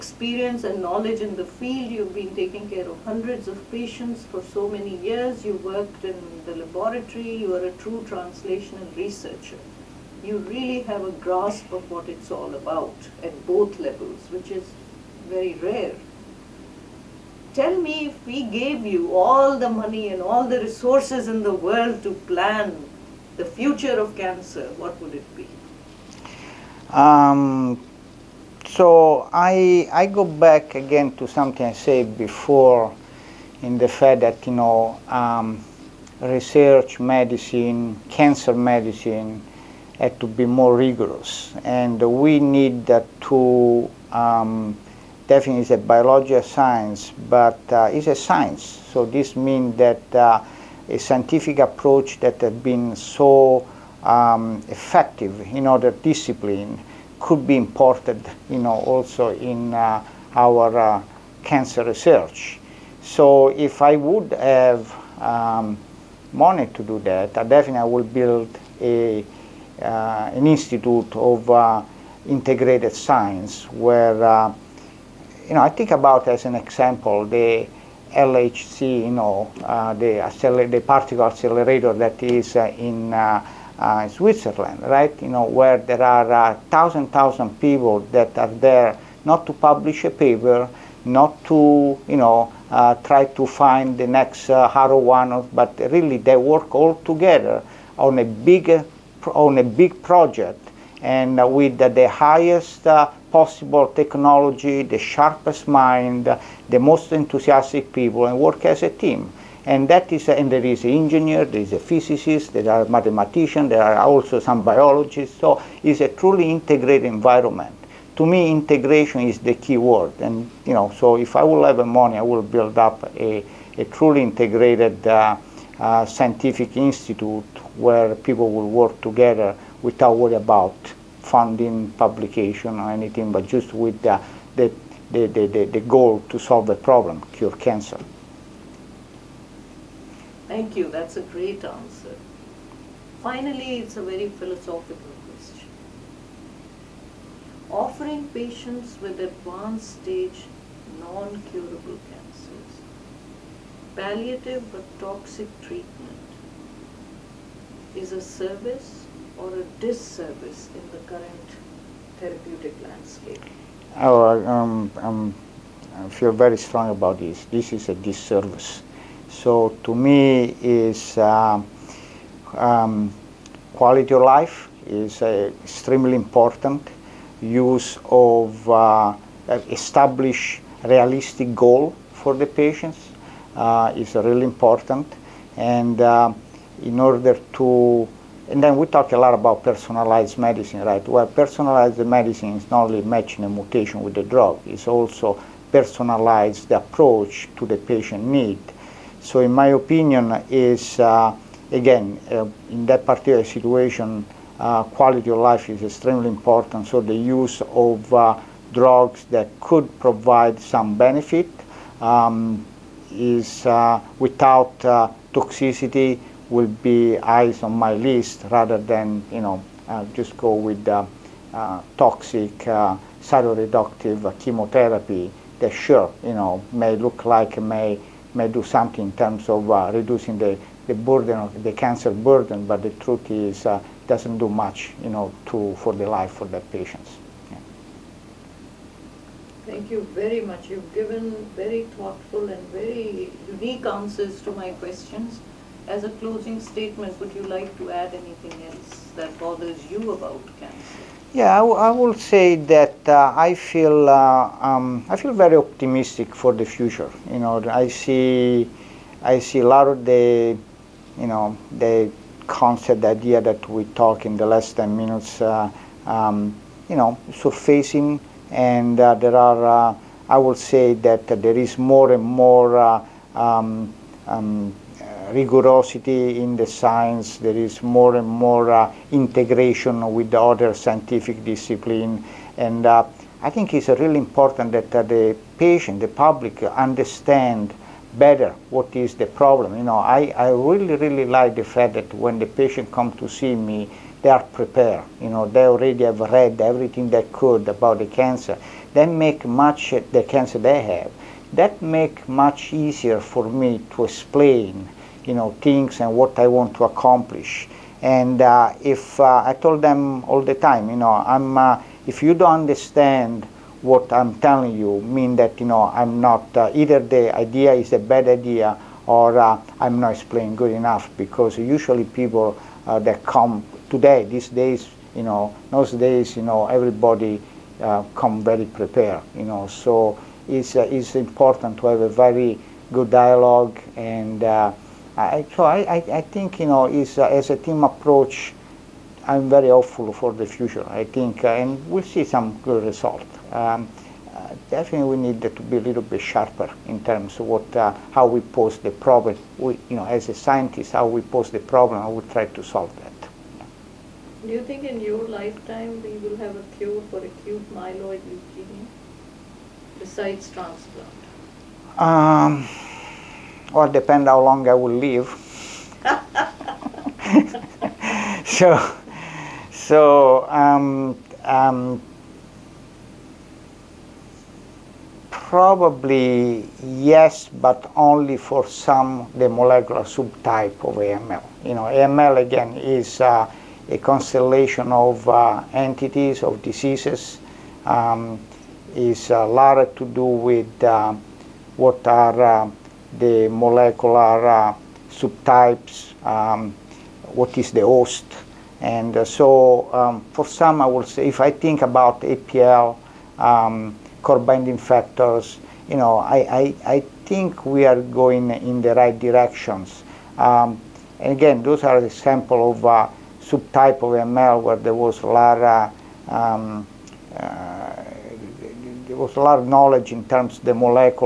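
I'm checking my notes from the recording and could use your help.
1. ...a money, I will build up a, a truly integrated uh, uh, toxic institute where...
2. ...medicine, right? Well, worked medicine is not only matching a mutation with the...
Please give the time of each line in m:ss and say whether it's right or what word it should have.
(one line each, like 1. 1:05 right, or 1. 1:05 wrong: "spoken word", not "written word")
1. 2:01 wrong: "scientific", not "toxic"
2. 3:10 wrong: "personalized", not "worked".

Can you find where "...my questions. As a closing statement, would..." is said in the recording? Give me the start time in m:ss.
4:04.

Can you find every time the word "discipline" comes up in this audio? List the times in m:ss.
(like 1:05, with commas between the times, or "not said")
0:55, 4:41.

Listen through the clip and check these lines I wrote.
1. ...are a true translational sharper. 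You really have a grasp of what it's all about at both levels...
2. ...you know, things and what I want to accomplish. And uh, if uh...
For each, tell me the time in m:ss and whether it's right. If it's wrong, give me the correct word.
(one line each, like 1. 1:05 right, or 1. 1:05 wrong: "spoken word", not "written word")
1. 0:07 wrong: "researcher", not "sharper"
2. 5:05 right.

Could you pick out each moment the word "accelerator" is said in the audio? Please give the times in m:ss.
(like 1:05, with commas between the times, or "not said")
1:21.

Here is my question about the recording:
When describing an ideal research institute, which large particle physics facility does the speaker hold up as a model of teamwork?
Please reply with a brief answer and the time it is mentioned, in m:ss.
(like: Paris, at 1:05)
LHC, at 1:18.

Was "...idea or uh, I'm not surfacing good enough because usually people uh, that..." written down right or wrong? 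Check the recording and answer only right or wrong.
wrong.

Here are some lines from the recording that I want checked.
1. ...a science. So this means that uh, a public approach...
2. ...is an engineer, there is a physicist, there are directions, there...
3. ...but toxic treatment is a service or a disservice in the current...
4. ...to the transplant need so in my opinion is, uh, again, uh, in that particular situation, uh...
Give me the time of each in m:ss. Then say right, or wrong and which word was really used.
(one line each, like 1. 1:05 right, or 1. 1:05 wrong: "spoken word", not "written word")
1. 0:48 wrong: "scientific", not "public"
2. 1:50 wrong: "mathematicians", not "directions"
3. 2:34 right
4. 3:17 wrong: "patient", not "transplant".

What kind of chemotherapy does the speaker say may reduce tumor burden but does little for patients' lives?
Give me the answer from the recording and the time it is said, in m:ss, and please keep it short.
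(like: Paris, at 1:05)
Cytoreductive chemotherapy, at 3:43.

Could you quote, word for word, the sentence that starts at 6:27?
Um, is a uh, lot to do with uh, what are uh, the molecular uh, subtypes, um, what is the host.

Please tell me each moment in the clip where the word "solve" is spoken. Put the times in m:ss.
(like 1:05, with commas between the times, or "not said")
2:16, 5:52.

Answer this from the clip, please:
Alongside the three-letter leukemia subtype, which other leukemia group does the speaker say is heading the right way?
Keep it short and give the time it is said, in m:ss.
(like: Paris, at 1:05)
Core binding factors, at 6:44.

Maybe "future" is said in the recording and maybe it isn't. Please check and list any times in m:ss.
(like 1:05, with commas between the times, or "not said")
0:23, 4:16, 5:40.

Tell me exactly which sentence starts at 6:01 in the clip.
Um, well, depend how long I will live.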